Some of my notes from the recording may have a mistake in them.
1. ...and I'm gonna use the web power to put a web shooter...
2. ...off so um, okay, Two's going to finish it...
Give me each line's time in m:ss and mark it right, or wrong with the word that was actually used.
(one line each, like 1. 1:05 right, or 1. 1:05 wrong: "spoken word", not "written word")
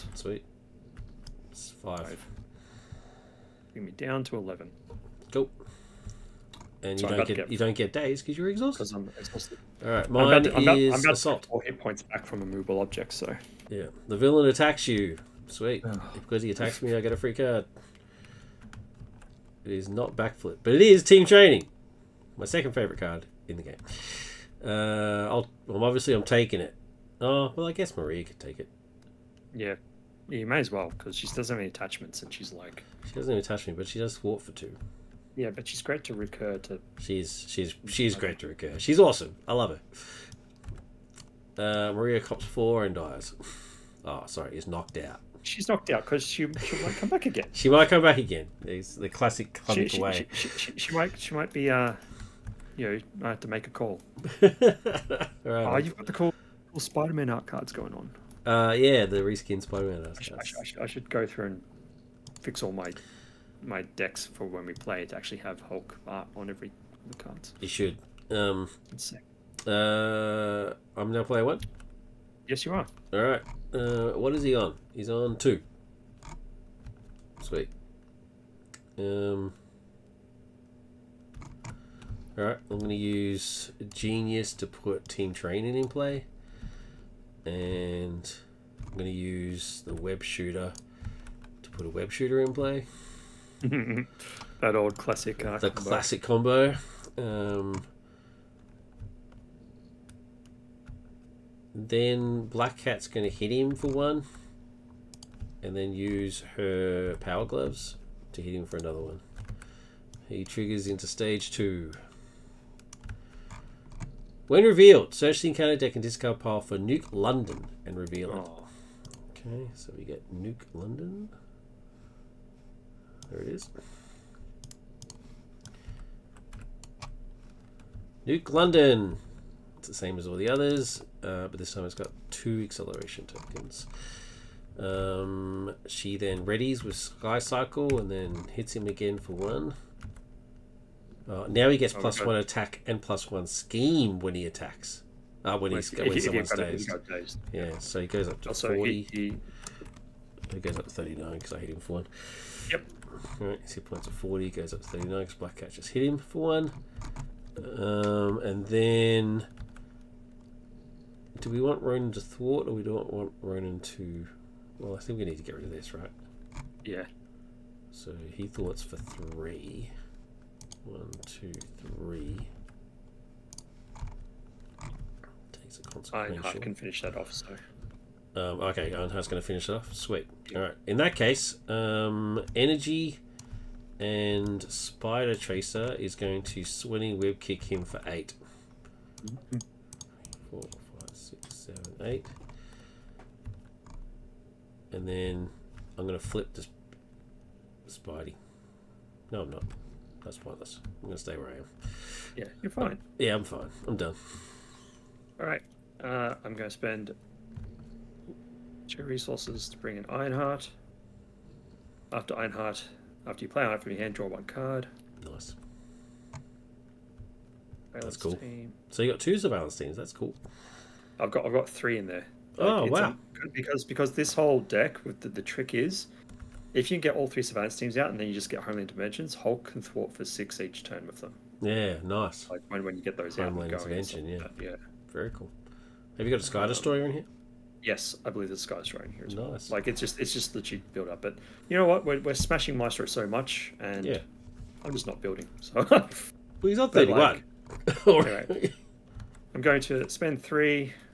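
1. 1:27 wrong: "shooter", not "power"
2. 2:57 wrong: "Ironheart", not "Two".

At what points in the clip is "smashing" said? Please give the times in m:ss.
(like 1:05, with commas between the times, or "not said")
4:02.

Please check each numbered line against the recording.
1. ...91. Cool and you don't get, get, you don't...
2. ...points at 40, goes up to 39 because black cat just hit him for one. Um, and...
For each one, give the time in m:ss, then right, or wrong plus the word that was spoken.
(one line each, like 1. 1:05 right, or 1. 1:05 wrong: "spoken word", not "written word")
1. 0:04 wrong: "11", not "91"
2. 2:33 right.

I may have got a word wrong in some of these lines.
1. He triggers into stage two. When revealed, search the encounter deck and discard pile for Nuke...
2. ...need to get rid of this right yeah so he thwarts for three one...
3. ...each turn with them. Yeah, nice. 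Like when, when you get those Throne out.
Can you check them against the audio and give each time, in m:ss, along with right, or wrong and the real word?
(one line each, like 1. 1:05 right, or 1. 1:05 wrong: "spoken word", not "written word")
1. 1:50 right
2. 2:45 right
3. 3:50 wrong: "Homeland", not "Throne".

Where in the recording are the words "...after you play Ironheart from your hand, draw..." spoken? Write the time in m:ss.
3:33.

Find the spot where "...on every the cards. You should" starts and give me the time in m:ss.
1:06.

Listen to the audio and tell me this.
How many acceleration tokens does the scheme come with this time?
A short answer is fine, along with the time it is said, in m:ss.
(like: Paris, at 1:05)
2, at 2:12.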